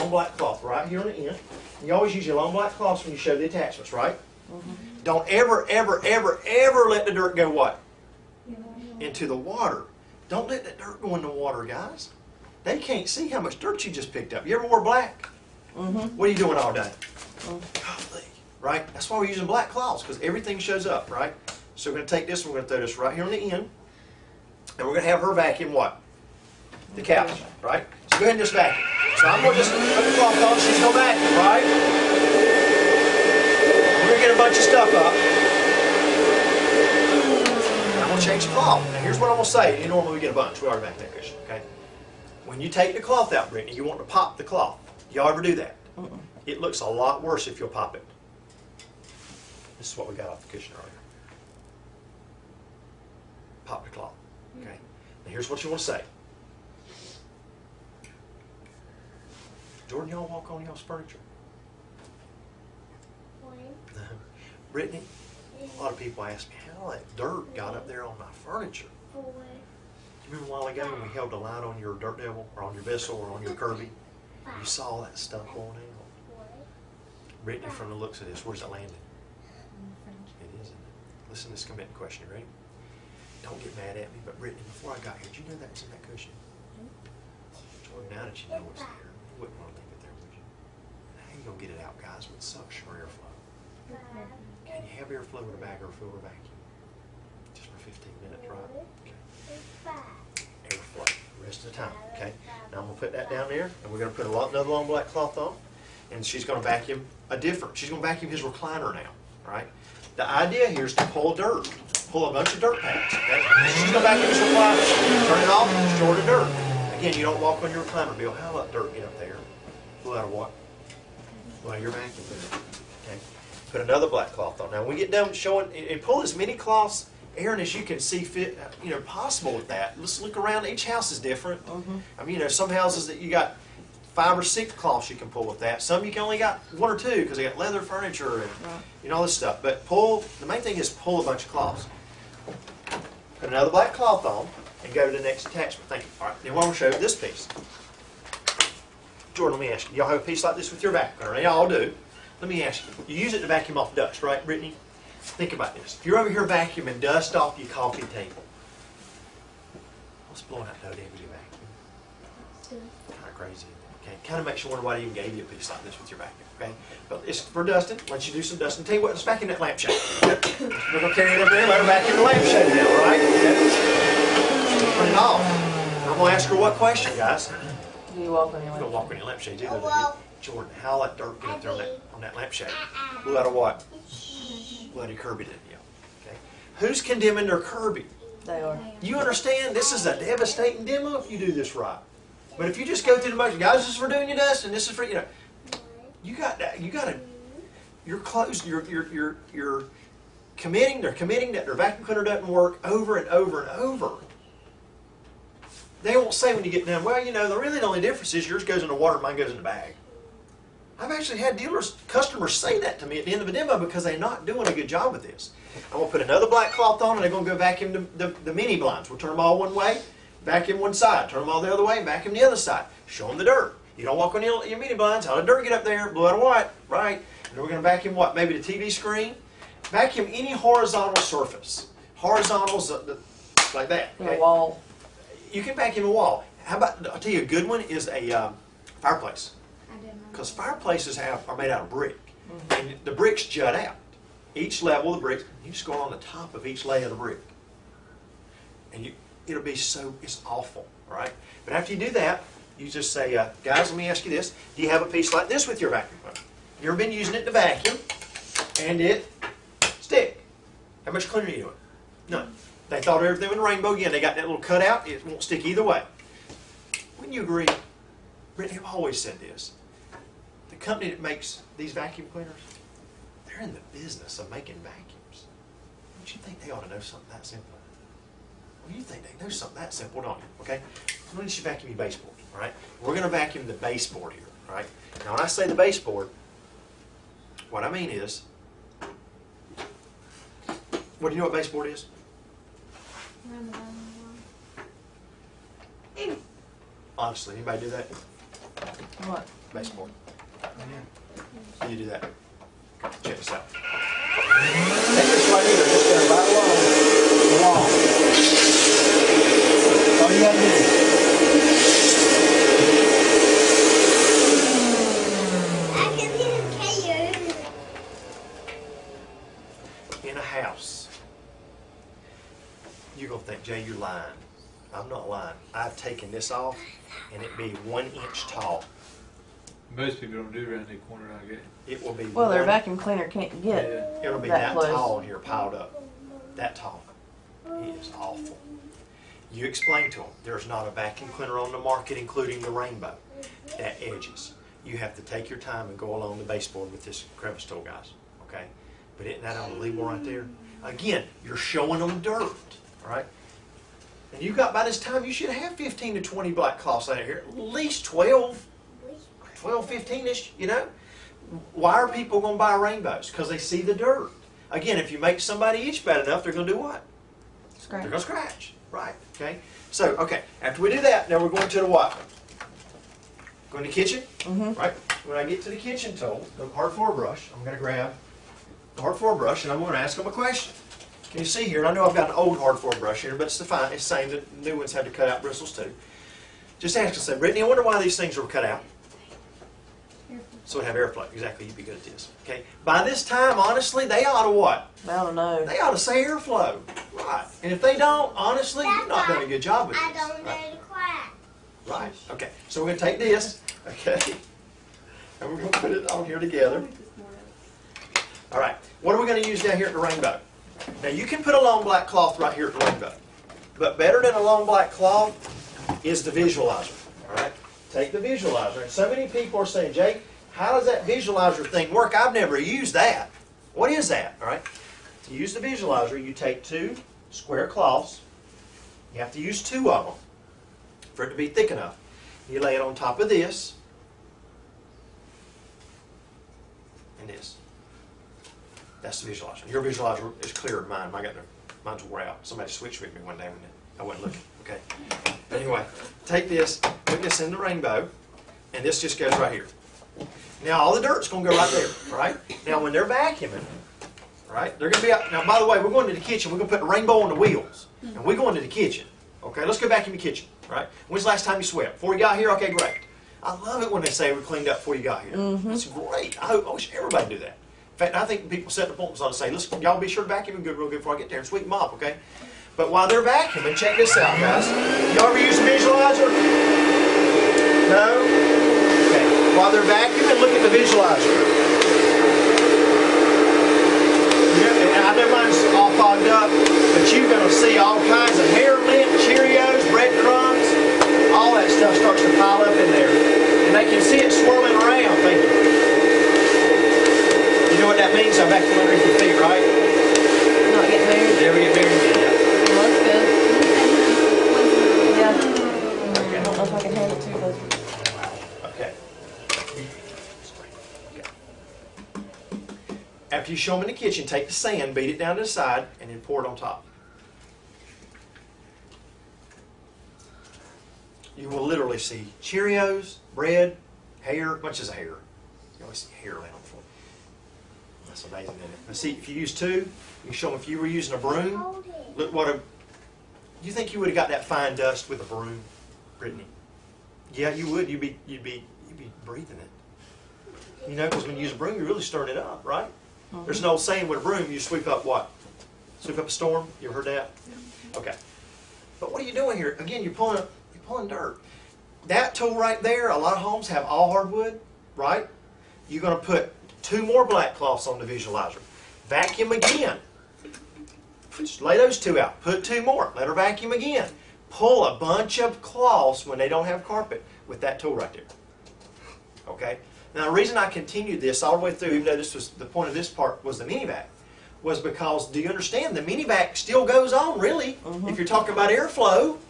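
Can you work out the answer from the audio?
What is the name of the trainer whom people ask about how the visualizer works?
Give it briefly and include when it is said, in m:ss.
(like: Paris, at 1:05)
Jake, at 6:59.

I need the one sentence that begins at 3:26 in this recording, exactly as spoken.
They won't say when you get done.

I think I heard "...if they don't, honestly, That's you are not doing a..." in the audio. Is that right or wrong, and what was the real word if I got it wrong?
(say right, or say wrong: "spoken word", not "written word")
right.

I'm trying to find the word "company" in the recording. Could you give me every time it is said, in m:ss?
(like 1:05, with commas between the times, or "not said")
4:30.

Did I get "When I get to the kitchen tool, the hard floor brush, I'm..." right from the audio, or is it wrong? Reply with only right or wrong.
right.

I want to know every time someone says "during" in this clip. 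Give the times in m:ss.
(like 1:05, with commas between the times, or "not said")
not said.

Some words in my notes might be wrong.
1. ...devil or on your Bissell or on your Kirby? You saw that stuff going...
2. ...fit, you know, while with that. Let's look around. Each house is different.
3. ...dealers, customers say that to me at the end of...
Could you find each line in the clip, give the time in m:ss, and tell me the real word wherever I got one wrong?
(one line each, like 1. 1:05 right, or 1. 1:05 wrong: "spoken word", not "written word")
1. 1:12 right
2. 2:08 wrong: "possible", not "while"
3. 3:31 right.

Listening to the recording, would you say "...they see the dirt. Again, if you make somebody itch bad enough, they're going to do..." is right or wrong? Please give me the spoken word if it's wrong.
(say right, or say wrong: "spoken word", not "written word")
right.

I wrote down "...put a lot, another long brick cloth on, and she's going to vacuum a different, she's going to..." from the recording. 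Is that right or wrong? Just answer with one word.
wrong.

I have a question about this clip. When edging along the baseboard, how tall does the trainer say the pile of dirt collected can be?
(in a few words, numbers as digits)
1 inch.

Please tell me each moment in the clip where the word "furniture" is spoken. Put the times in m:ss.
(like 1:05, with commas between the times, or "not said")
1:00, 1:08, 2:17.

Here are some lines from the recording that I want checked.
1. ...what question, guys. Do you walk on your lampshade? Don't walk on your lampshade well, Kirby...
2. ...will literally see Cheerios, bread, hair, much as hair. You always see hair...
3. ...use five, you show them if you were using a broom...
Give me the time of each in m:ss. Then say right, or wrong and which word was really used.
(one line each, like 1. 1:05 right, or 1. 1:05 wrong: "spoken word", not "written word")
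1. 2:56 wrong: "Jordan", not "Kirby"
2. 8:41 right
3. 8:49 wrong: "two", not "five".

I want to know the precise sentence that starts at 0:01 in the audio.
And you always use your long black cloths when you show the attachments, right?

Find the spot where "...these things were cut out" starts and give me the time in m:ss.
6:28.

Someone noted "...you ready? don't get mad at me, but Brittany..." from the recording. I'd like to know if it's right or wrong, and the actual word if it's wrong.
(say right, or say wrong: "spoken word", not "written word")
right.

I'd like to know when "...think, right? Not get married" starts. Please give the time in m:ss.
8:19.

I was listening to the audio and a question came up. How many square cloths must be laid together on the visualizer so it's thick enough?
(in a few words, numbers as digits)
2.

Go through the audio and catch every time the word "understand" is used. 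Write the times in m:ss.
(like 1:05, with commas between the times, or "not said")
3:09, 9:35.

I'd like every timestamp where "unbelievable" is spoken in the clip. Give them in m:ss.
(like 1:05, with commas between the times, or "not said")
5:49.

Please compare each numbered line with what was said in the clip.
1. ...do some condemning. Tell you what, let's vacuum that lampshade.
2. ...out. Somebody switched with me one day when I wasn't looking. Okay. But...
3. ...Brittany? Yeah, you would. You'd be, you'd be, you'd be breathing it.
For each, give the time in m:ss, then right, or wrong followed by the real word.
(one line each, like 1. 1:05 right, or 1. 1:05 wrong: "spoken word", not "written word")
1. 2:48 wrong: "dusting", not "condemning"
2. 7:22 right
3. 8:56 right.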